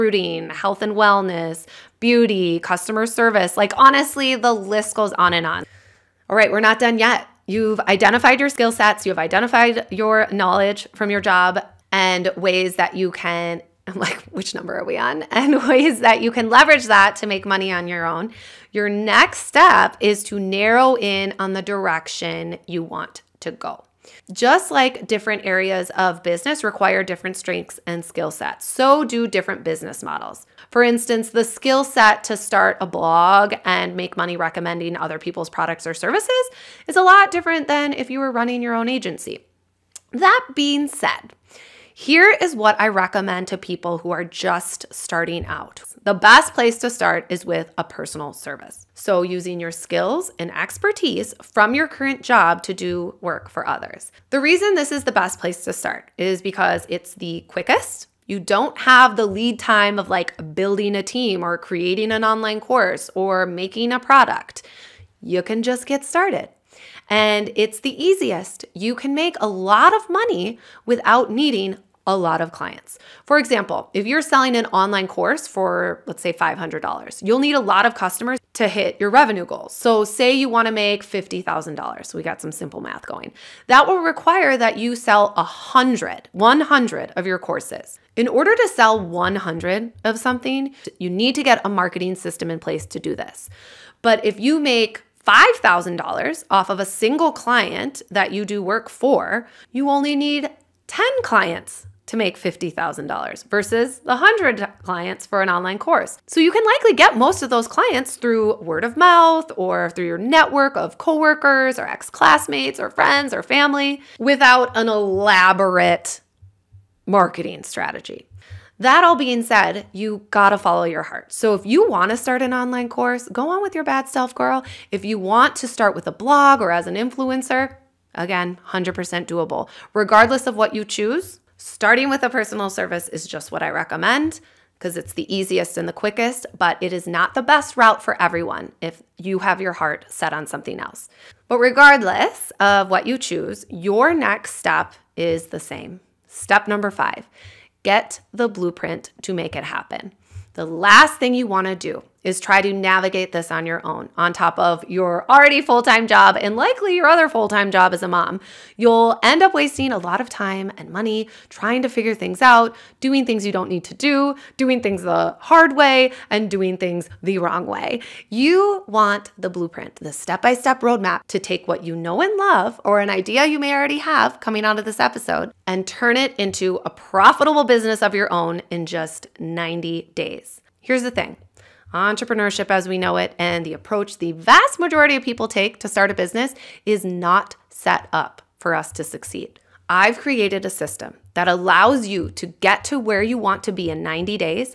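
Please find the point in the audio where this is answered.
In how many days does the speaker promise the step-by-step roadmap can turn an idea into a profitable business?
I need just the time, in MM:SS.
02:59.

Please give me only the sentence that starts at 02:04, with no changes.
If you want to start with a blog or as an influencer, Again, 100% doable.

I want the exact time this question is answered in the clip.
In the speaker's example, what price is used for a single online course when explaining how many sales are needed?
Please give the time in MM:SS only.
01:16.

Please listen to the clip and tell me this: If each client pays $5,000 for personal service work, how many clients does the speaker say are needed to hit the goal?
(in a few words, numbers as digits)
10.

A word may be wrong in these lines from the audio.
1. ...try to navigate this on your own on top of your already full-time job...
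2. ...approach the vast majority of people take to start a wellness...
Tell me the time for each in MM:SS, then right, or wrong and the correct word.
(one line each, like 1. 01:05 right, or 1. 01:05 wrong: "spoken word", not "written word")
1. 02:32 right
2. 03:03 wrong: "business", not "wellness".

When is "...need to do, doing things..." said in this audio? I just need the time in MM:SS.
02:43.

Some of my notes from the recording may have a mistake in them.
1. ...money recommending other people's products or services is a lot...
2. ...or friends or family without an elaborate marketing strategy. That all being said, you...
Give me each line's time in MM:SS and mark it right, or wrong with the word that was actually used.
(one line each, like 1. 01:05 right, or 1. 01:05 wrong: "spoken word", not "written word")
1. 00:34 right
2. 01:52 right.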